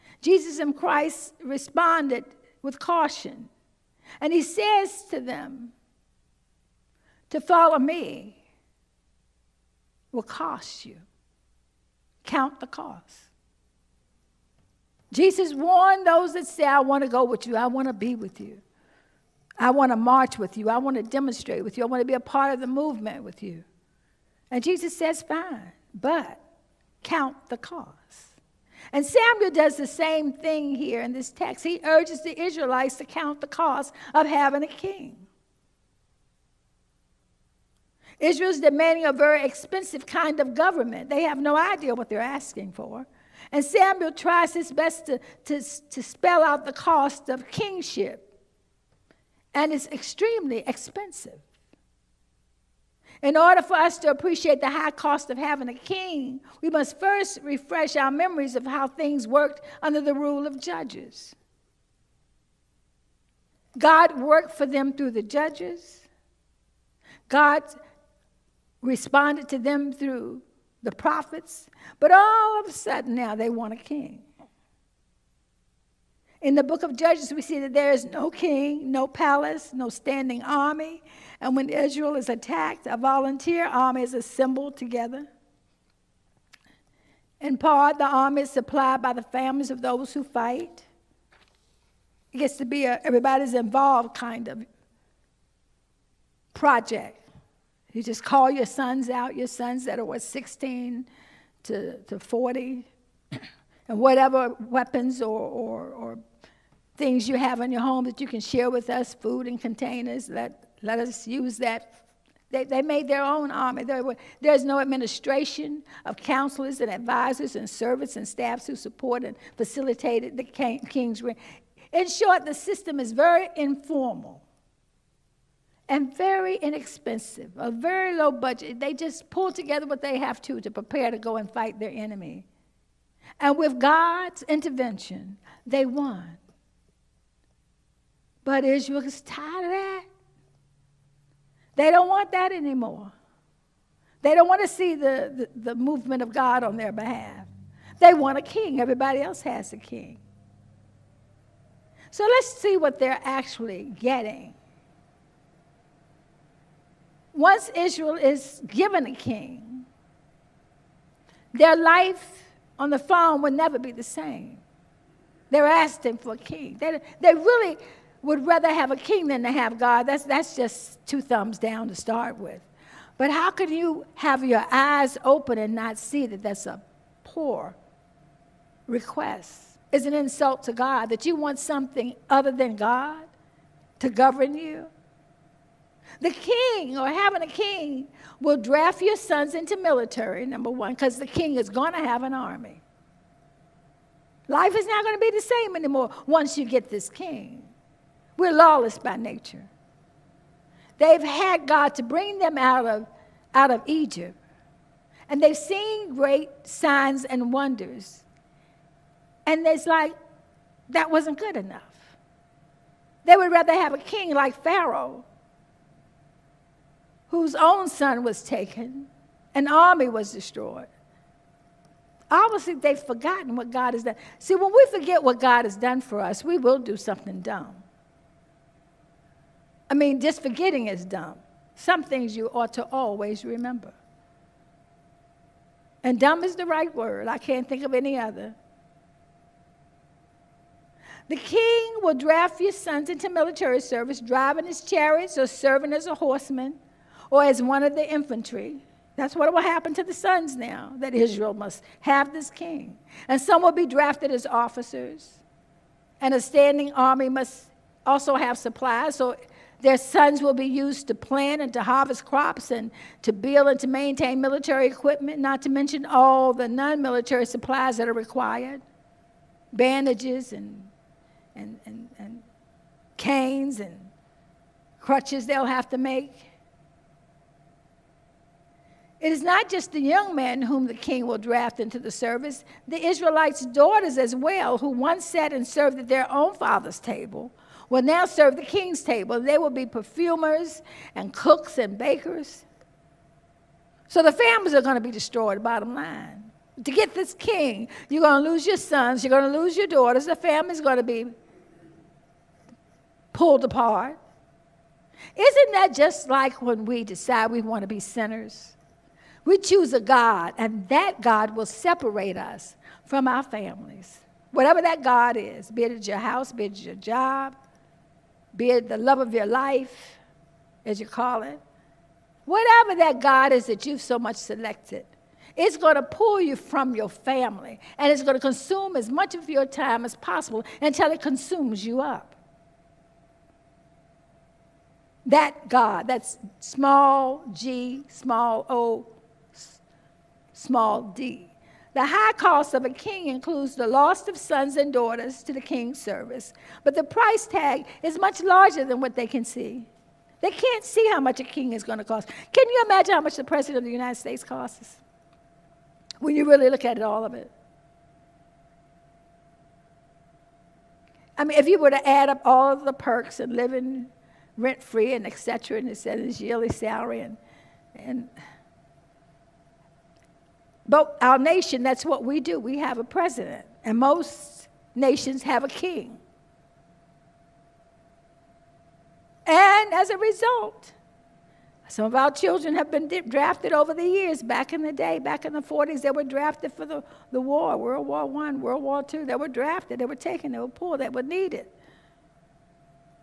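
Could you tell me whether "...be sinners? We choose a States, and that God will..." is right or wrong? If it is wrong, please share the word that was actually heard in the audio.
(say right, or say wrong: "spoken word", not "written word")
wrong: "God", not "States".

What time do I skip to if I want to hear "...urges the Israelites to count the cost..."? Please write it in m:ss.
0:31.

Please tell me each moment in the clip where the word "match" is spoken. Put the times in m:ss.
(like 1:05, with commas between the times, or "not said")
not said.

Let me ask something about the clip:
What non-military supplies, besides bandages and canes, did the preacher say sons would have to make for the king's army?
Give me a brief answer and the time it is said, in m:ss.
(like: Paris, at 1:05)
Crutches, at 4:35.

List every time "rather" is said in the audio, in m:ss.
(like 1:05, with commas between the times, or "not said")
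2:48, 3:33.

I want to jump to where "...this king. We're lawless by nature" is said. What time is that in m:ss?
3:16.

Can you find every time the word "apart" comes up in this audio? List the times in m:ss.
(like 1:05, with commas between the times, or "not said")
5:03.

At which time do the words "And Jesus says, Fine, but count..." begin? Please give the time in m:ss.
0:24.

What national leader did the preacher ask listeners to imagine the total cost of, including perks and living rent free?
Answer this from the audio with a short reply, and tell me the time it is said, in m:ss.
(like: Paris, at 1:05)
President of the United States, at 5:53.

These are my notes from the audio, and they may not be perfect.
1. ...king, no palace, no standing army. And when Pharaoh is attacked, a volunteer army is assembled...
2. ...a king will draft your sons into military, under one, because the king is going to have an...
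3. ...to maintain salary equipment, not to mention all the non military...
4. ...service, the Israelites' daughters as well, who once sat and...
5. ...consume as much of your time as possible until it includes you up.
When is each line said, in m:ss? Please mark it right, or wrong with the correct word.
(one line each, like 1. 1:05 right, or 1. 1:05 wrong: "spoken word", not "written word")
1. 1:18 wrong: "Israel", not "Pharaoh"
2. 3:07 wrong: "number", not "under"
3. 4:23 wrong: "military", not "salary"
4. 4:42 right
5. 5:28 wrong: "consumes", not "includes".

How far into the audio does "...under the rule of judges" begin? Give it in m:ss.
0:59.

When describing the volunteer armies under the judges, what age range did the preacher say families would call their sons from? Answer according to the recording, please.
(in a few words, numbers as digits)
16 to 40.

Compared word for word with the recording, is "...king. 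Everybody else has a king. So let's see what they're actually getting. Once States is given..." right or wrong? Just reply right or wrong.
wrong.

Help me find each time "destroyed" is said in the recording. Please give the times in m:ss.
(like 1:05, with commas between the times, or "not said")
3:40, 4:55.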